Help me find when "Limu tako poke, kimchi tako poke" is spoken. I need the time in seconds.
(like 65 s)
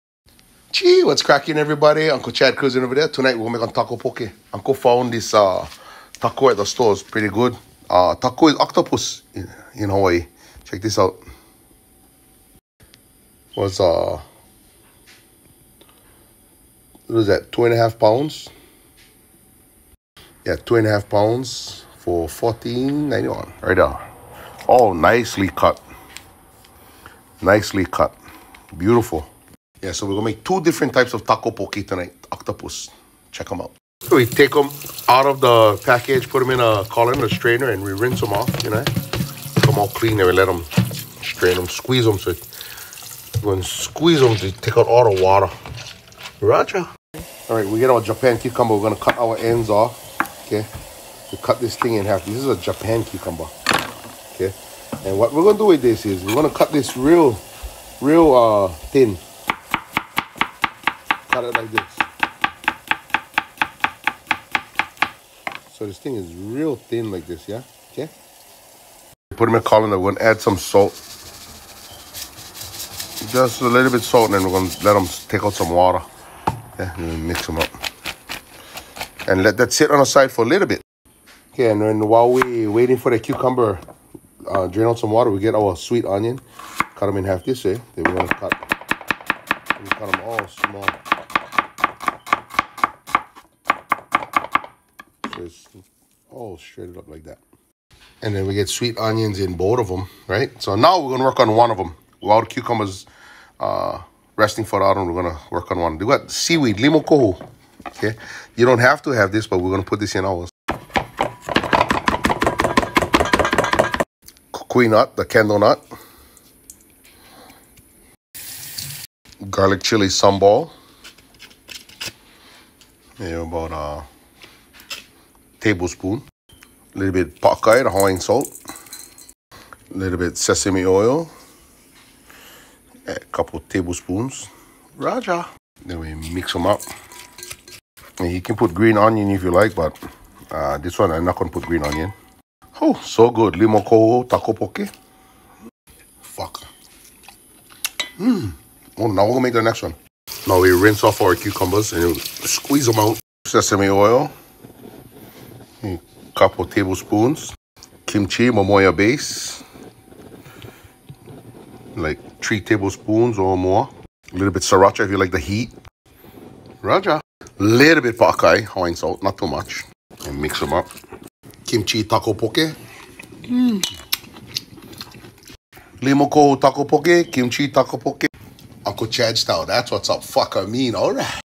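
176 s.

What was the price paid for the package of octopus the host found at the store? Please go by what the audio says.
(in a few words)
$14.91.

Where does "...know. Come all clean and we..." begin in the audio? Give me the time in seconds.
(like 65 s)
38 s.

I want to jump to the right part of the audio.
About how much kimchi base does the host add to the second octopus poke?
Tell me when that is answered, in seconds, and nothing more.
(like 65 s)
162 s.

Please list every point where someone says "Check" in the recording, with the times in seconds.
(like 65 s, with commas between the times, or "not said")
10 s, 33 s.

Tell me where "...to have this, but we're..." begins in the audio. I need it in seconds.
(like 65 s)
109 s.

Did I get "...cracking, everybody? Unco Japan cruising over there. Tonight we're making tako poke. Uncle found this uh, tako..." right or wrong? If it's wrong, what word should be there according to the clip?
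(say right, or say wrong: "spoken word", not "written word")
wrong: "Chad", not "Japan".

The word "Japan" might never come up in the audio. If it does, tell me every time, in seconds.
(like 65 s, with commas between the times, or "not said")
48 s, 52 s.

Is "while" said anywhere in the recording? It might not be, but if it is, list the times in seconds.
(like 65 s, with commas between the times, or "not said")
82 s, 102 s.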